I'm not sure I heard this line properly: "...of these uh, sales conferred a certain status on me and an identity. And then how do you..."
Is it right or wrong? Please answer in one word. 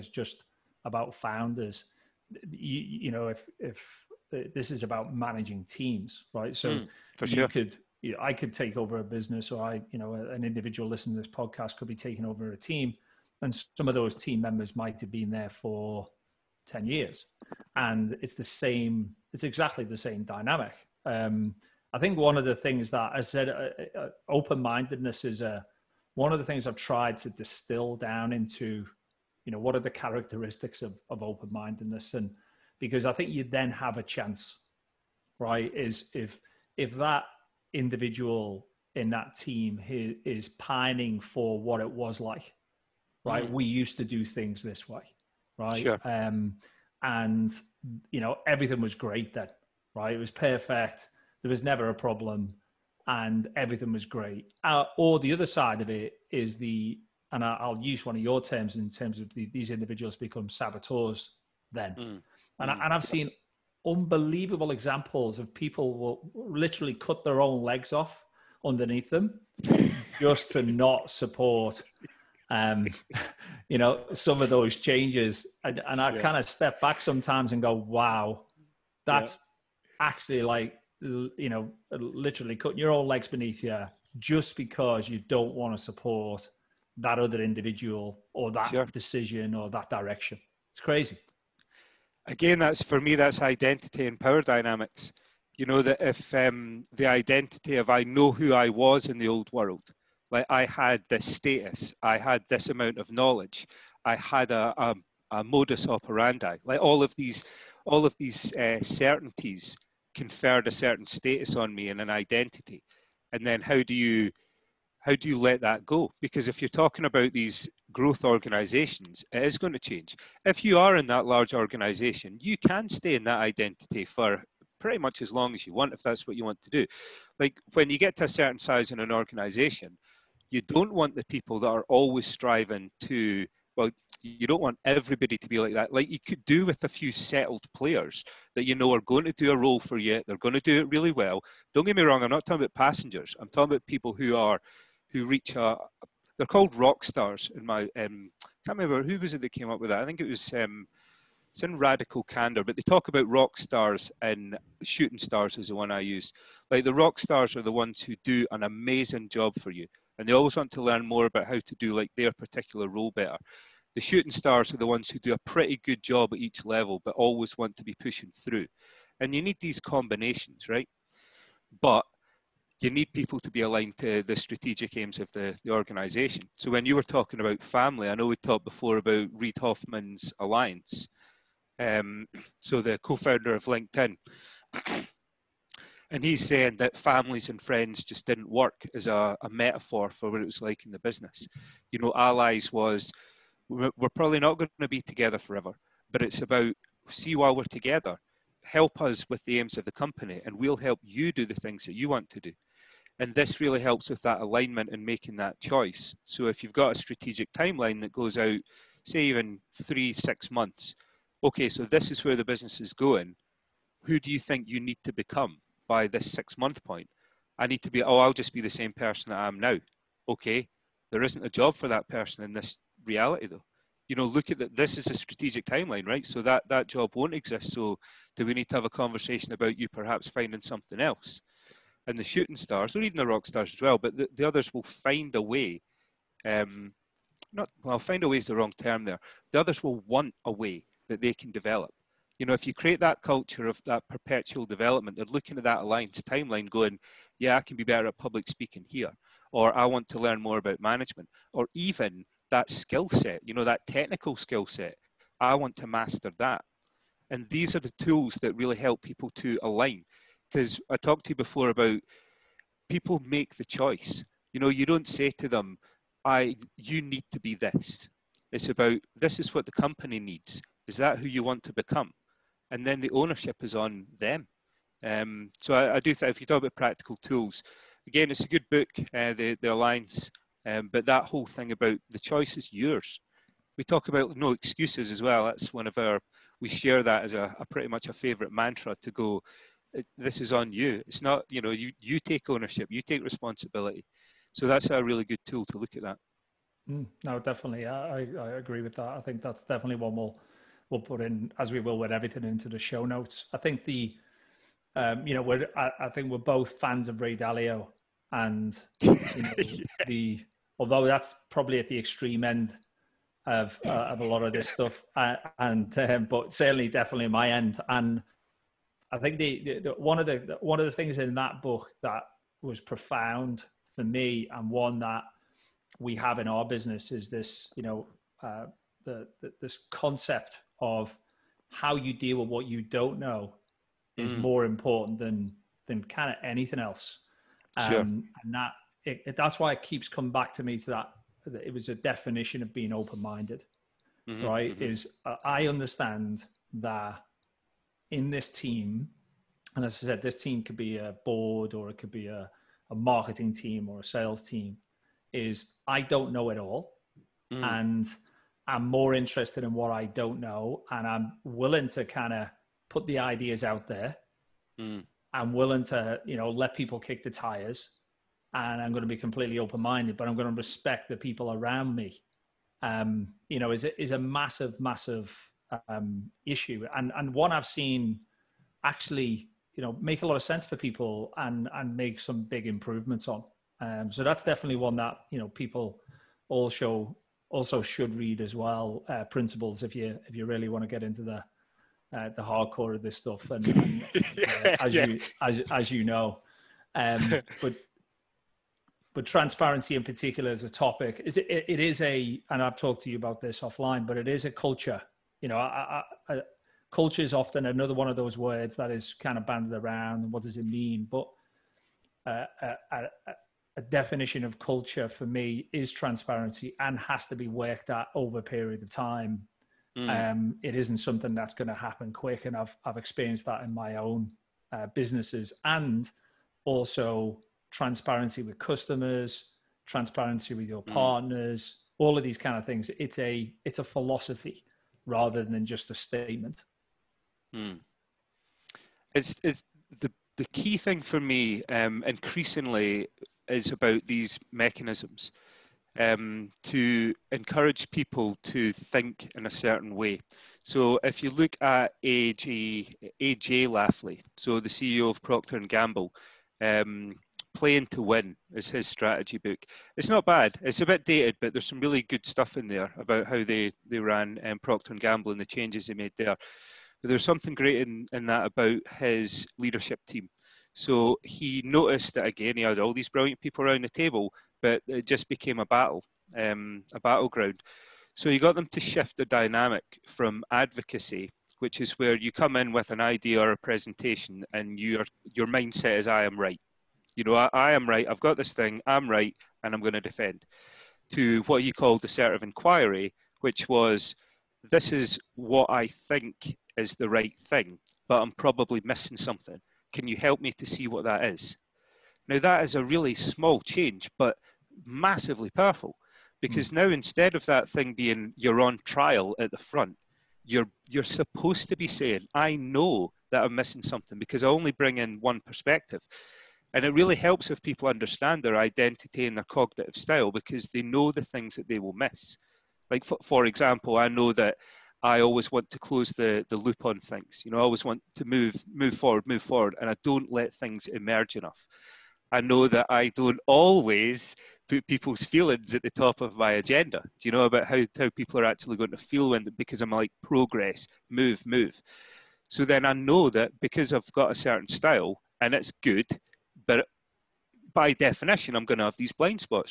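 wrong.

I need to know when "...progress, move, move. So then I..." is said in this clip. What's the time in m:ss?
9:00.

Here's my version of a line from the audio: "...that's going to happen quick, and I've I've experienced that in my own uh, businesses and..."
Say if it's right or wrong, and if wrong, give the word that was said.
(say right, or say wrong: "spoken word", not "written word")
right.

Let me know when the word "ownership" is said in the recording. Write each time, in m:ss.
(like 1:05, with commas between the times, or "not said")
4:33, 4:52.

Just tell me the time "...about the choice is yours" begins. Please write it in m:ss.
4:41.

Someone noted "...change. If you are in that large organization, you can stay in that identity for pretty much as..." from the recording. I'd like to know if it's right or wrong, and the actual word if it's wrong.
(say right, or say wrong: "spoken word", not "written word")
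right.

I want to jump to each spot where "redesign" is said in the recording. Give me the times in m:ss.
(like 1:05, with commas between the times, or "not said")
not said.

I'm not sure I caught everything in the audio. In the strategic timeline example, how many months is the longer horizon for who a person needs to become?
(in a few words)
6 months.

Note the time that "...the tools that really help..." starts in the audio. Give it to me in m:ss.
4:17.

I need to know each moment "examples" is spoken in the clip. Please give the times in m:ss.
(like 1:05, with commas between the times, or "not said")
1:04, 8:43.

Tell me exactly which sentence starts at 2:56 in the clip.
So when you were talking about family, I know we talked before about Reid Hoffman's alliance.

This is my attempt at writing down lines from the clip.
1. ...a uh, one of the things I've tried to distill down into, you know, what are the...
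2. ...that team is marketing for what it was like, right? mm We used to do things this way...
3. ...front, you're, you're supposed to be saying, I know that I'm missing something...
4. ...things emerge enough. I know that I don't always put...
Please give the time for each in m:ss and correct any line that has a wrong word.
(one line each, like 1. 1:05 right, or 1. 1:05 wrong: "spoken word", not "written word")
1. 0:25 right
2. 0:39 wrong: "pining", not "marketing"
3. 8:29 right
4. 8:50 right.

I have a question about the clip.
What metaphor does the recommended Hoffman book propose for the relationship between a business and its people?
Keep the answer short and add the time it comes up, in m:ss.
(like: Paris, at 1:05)
Allies, at 3:12.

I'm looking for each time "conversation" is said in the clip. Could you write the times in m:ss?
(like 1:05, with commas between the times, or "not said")
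3:48.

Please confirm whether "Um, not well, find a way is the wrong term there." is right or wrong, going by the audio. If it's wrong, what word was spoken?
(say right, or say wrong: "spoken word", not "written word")
right.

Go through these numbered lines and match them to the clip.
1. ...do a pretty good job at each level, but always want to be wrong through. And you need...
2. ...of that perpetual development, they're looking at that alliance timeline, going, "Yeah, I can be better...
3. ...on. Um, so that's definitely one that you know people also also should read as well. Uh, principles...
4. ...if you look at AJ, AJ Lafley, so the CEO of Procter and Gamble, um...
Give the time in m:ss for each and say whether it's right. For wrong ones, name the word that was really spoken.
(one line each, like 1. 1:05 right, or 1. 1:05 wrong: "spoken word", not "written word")
1. 2:45 wrong: "pushing", not "wrong"
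2. 4:03 right
3. 6:23 right
4. 7:31 right.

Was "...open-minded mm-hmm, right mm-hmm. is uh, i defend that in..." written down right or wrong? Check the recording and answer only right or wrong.
wrong.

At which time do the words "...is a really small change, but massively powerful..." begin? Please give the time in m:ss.
8:22.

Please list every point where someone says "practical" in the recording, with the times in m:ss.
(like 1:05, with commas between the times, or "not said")
4:36.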